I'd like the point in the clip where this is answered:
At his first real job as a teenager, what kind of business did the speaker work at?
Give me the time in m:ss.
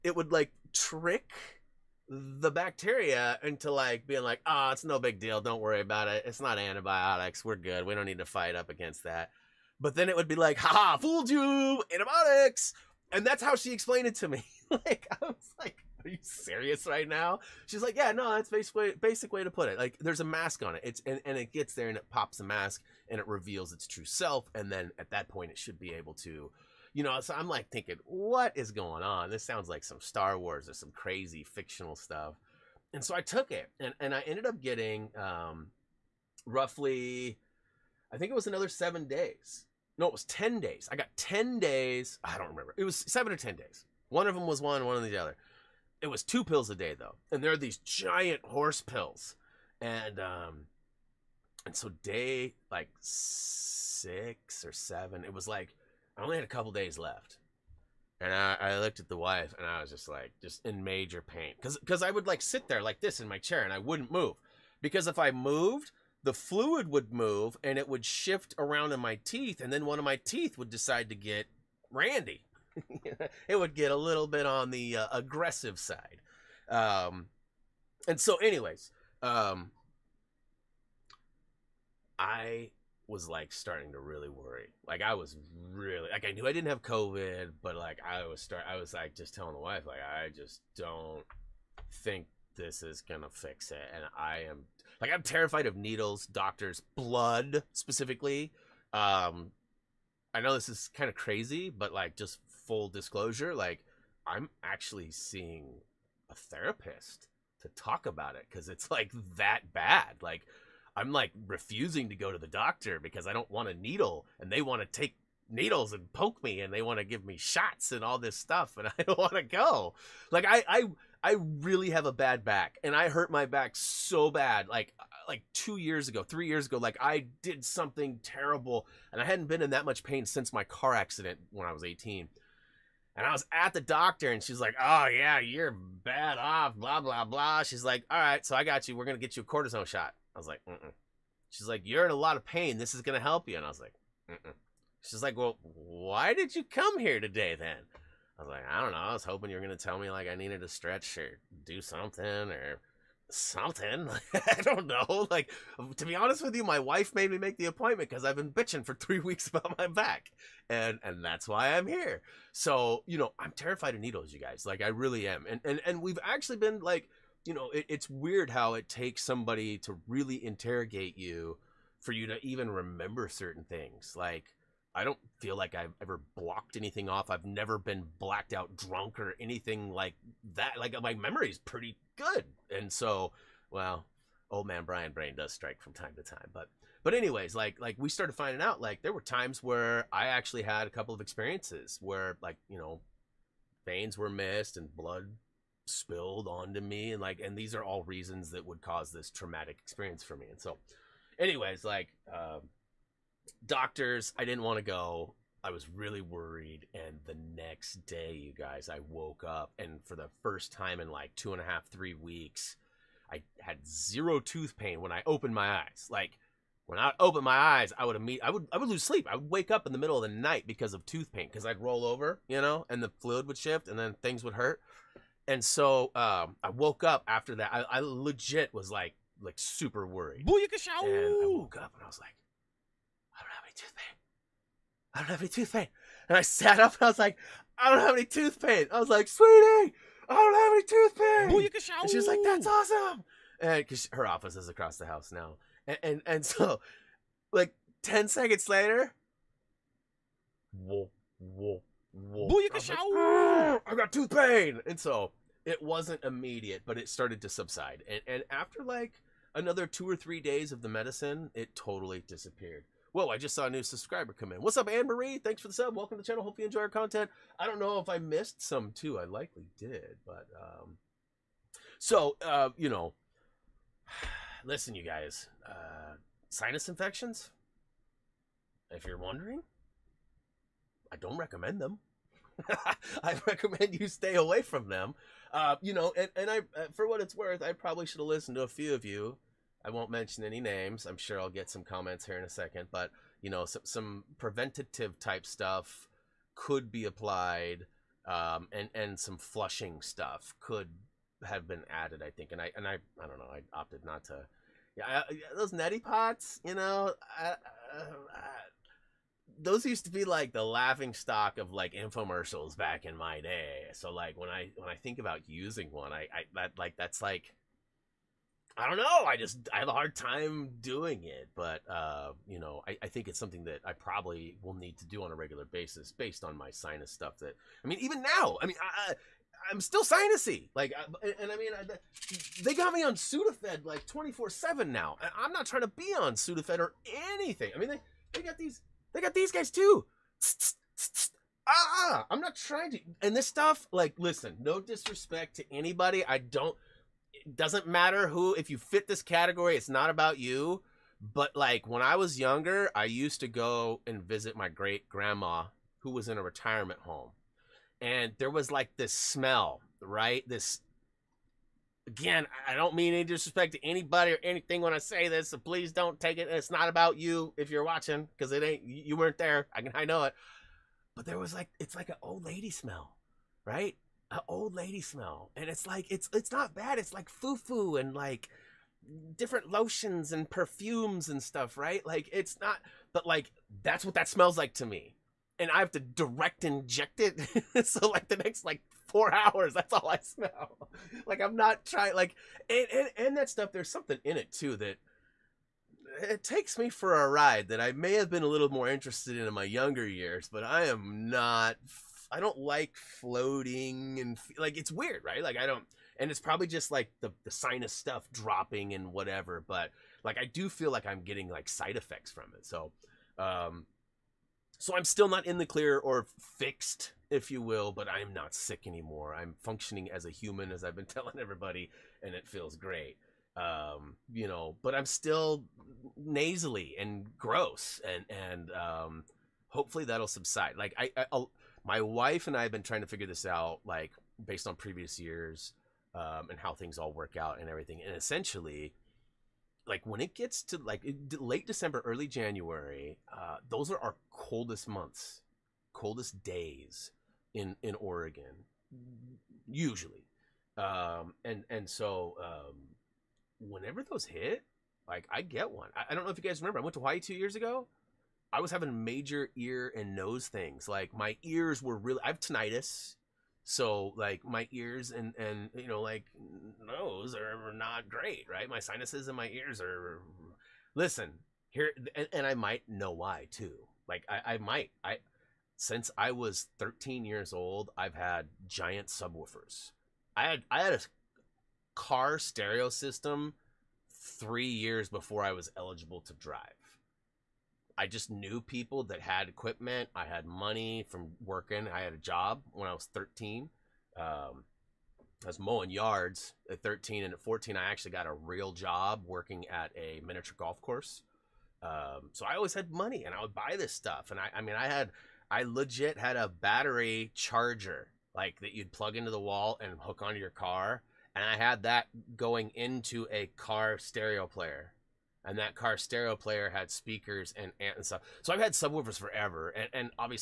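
8:20.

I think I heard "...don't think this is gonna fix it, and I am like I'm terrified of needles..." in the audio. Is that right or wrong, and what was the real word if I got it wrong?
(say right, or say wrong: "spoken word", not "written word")
right.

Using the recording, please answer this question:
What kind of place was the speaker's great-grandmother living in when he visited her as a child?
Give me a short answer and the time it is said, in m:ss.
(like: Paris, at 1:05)
retirement home, at 5:56.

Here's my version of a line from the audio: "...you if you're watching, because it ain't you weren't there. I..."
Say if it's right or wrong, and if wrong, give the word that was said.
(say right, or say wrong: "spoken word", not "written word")
right.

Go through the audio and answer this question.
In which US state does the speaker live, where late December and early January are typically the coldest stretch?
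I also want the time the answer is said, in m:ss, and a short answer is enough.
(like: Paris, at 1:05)
Oregon, at 7:27.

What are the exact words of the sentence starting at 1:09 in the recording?
And then one of my teeth would decide to get randy.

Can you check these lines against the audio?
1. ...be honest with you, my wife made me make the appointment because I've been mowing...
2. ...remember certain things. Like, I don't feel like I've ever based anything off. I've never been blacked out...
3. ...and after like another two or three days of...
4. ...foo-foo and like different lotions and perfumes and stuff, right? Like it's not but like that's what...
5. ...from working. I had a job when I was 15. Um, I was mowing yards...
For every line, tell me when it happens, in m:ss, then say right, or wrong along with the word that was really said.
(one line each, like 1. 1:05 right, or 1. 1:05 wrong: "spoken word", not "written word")
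1. 2:36 wrong: "bitching", not "mowing"
2. 2:52 wrong: "blocked", not "based"
3. 4:18 right
4. 6:17 right
5. 8:11 wrong: "13", not "15".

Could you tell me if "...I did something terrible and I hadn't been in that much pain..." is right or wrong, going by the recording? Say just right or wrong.
right.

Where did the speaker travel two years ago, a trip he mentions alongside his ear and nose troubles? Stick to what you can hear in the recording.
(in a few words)
Hawaii.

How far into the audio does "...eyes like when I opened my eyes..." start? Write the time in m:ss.
3:35.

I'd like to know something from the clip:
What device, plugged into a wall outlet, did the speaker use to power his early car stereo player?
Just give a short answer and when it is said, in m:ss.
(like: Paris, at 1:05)
battery charger, at 8:26.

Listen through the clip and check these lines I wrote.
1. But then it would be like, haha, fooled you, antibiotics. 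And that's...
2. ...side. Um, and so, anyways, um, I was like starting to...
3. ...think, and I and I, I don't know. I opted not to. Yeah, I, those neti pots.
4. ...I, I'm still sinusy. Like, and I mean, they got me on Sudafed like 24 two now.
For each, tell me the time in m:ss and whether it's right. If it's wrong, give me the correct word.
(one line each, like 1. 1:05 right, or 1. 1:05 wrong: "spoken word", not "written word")
1. 0:09 right
2. 1:15 right
3. 5:02 right
4. 5:29 wrong: "seven", not "two".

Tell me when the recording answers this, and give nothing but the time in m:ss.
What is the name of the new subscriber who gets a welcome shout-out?
4:24.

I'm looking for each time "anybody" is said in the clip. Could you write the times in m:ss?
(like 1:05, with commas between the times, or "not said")
5:45, 6:03.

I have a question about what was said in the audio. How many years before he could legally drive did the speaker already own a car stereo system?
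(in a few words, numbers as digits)
3.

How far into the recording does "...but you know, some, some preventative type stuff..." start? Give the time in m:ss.
4:52.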